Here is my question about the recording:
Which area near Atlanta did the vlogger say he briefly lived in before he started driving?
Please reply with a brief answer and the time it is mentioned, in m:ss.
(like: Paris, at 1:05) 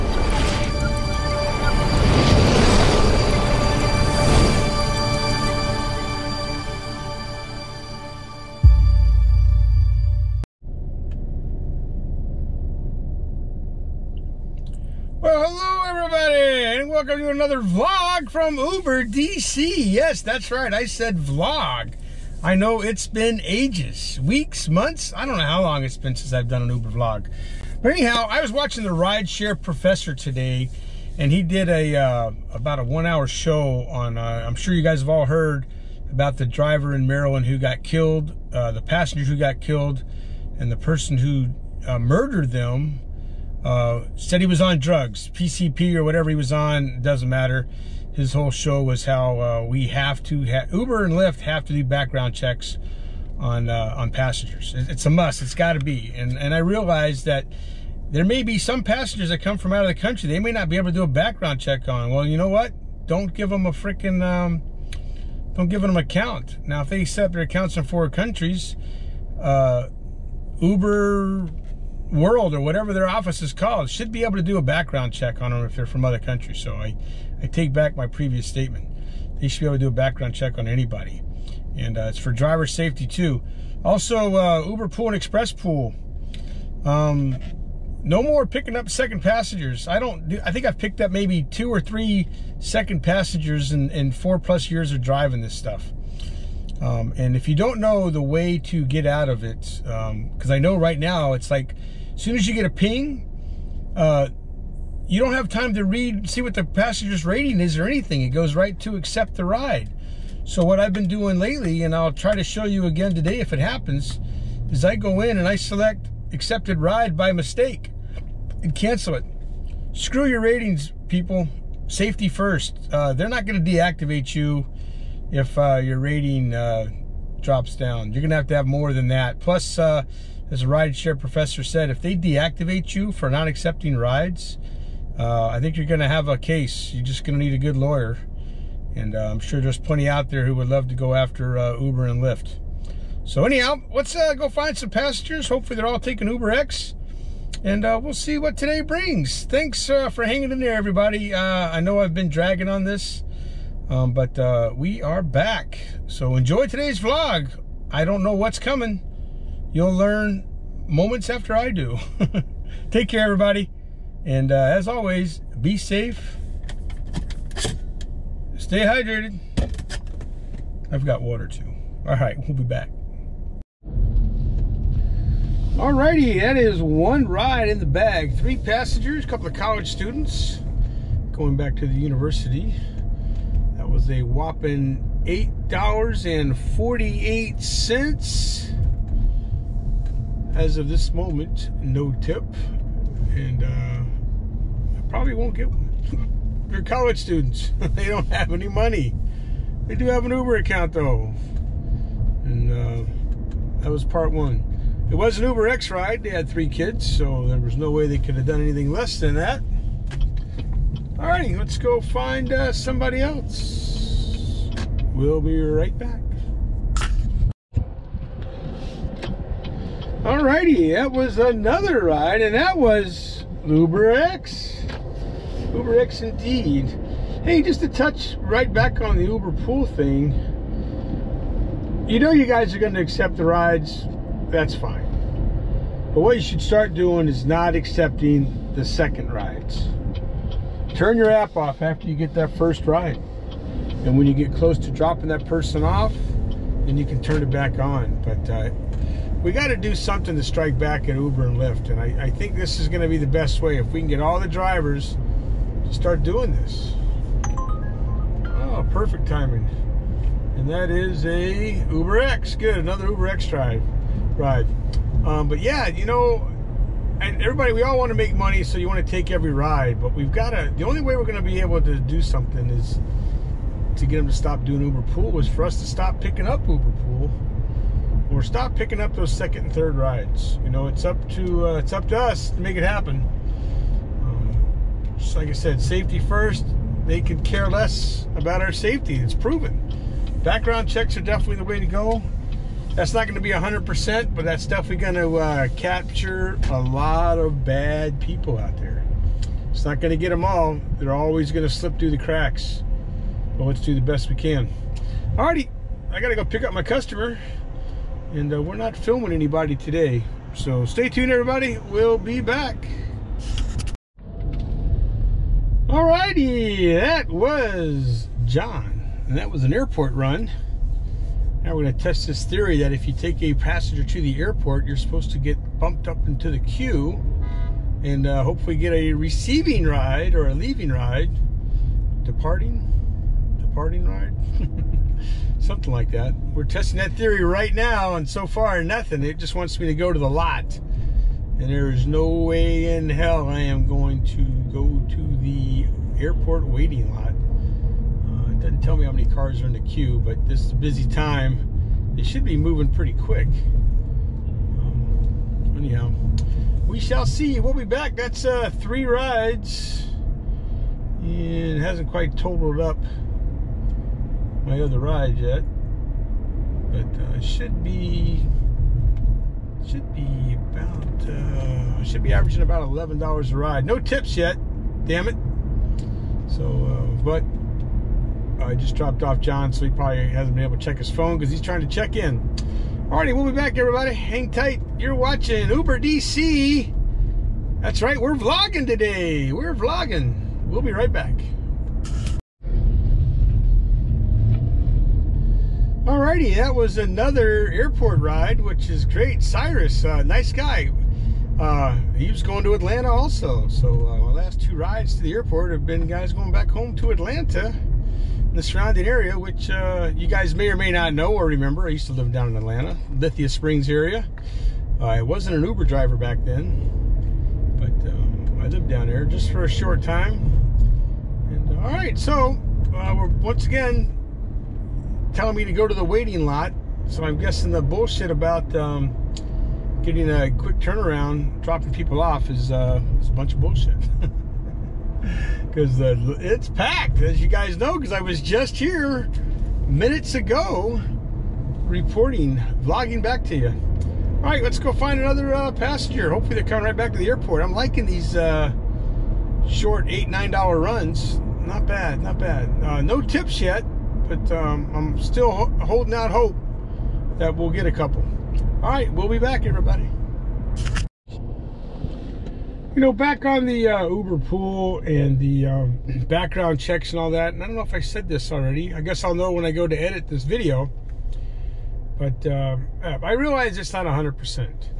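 Lithia Springs, at 6:53.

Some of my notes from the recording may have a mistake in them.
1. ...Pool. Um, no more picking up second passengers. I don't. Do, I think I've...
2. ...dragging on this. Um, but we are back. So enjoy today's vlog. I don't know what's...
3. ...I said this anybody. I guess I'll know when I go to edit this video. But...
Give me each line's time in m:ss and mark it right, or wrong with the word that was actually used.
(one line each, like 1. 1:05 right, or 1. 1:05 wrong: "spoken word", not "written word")
1. 1:25 right
2. 2:32 right
3. 7:47 wrong: "already", not "anybody".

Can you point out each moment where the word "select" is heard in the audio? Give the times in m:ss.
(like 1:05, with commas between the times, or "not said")
1:55.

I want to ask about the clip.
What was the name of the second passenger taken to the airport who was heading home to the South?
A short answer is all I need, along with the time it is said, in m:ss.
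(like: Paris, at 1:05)
Cyrus, at 6:39.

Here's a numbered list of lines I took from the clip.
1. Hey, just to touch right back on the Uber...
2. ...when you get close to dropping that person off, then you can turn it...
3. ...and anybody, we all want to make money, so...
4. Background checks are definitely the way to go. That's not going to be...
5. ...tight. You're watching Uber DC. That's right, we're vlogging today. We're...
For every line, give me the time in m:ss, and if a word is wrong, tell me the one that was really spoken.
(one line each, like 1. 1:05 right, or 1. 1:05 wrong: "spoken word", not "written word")
1. 3:47 right
2. 4:04 right
3. 4:27 wrong: "everybody", not "anybody"
4. 4:50 right
5. 6:24 right.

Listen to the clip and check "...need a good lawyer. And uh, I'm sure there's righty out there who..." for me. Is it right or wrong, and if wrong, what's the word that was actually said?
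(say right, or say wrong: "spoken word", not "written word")
wrong: "plenty", not "righty".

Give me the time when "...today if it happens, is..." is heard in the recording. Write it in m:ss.
1:53.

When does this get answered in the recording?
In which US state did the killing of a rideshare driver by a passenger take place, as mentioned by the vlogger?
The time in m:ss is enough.
0:37.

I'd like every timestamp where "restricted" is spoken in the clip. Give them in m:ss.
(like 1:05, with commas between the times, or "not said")
not said.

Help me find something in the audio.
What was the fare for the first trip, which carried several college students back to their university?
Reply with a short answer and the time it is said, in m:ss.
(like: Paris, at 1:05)
$8.48, at 3:05.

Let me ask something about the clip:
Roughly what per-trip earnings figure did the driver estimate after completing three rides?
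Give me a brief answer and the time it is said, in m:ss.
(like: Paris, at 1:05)
eleven dollars, at 6:12.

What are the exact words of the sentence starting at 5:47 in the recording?
Uh, it doesn't tell me how many cars are in the queue, but this is a busy time.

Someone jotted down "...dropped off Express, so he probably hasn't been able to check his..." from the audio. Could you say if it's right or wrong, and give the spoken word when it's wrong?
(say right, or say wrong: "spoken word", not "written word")
wrong: "John", not "Express".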